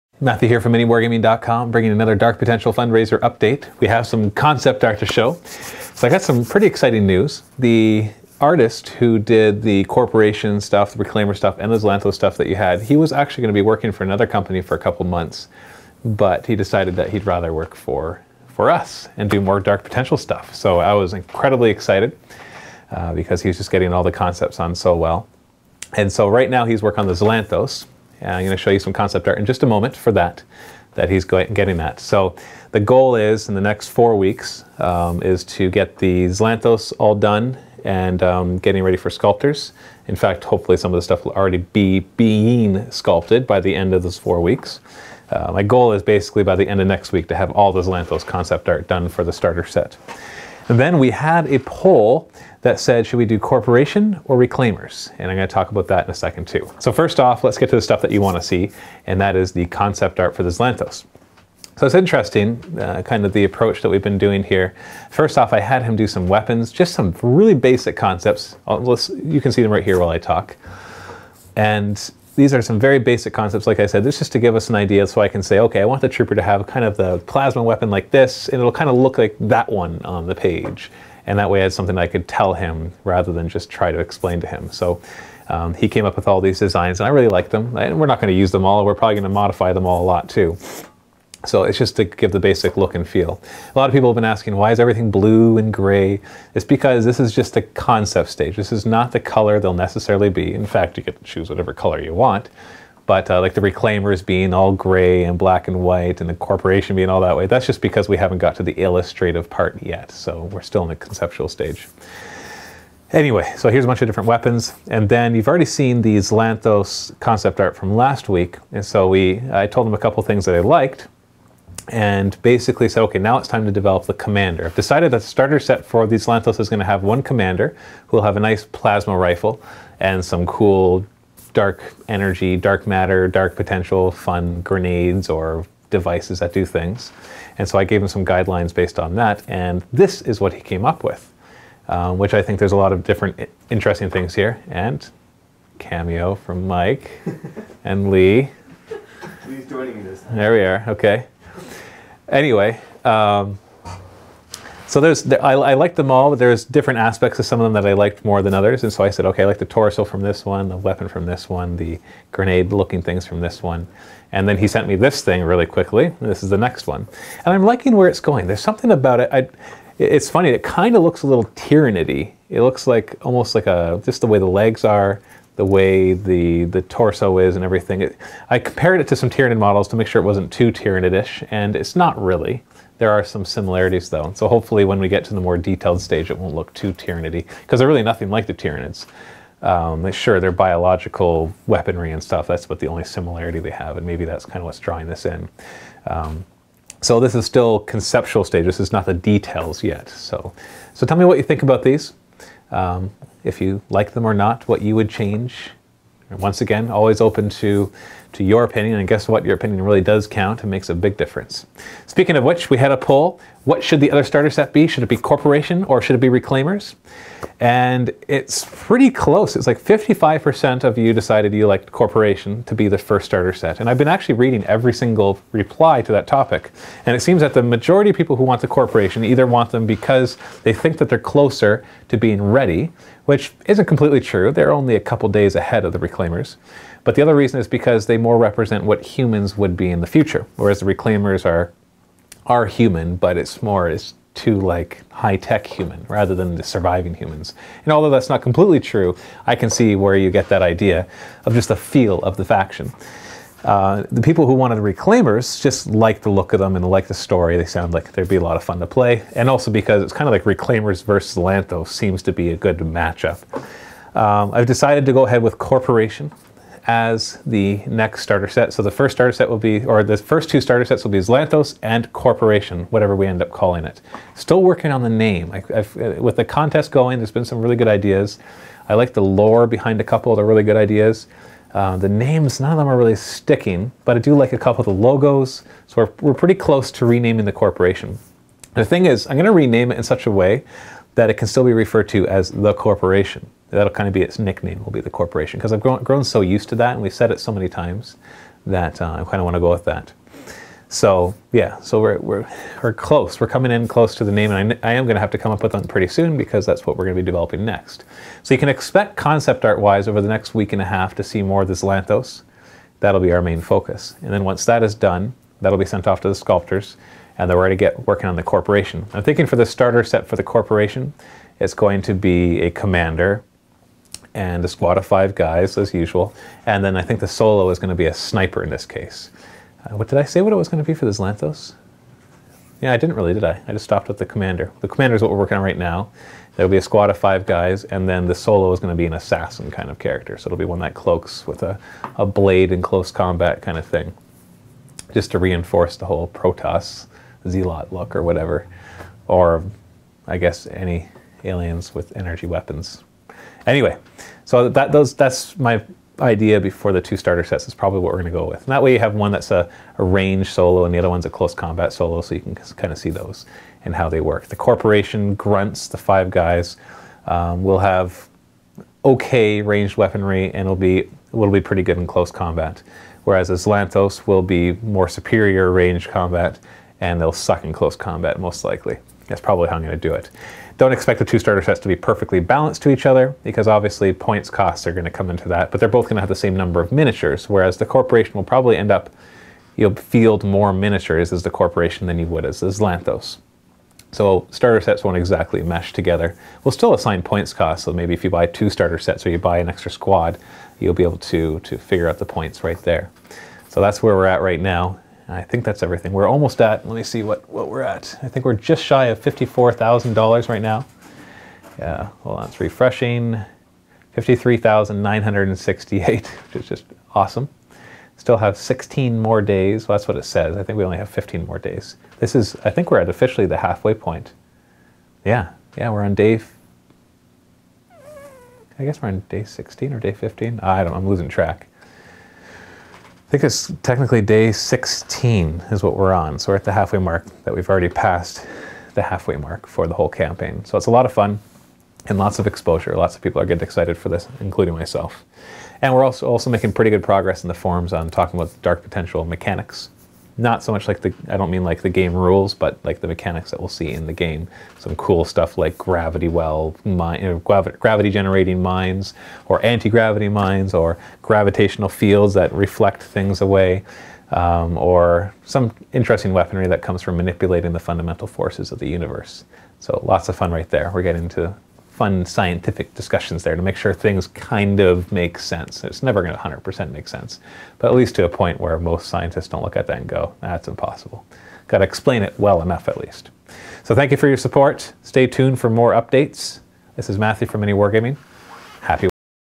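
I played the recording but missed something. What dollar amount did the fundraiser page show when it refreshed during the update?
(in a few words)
$53,968.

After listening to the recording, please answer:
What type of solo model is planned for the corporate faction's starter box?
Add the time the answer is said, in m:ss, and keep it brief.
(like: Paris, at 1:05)
sniper, at 5:28.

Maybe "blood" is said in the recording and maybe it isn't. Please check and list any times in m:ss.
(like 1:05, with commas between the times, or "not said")
not said.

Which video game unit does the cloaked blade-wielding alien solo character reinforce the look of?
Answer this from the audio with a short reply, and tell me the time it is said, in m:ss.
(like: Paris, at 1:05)
Protoss Zealot, at 5:46.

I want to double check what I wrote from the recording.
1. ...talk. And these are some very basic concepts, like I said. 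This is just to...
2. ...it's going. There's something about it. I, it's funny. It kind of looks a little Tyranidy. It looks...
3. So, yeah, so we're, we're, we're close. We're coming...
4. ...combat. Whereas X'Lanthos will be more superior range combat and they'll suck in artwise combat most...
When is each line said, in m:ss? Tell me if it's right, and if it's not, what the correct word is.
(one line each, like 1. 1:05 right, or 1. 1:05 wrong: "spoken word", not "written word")
1. 1:10 right
2. 2:48 right
3. 5:00 right
4. 6:12 wrong: "close", not "artwise".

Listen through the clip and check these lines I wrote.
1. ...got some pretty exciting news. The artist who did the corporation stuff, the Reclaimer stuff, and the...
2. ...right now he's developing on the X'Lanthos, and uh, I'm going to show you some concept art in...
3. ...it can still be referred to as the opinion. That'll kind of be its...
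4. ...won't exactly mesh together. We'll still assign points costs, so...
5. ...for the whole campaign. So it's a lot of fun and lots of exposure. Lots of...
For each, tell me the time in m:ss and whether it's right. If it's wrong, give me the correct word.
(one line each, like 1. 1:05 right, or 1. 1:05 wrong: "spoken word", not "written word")
1. 0:06 right
2. 0:26 wrong: "working", not "developing"
3. 4:51 wrong: "corporation", not "opinion"
4. 6:35 right
5. 7:19 right.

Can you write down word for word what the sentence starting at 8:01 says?
Got to explain it well enough at least.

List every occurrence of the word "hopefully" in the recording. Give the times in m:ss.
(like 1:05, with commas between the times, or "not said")
0:40, 3:04.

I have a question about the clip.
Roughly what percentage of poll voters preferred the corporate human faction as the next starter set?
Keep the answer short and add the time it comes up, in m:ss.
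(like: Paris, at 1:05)
55%, at 3:39.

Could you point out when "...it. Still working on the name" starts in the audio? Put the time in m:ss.
4:33.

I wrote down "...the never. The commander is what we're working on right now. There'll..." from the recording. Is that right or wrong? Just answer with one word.
wrong.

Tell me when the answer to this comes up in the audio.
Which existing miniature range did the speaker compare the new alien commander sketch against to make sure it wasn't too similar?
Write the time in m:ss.
2:59.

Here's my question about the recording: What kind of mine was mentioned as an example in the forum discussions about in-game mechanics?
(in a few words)
gravity well.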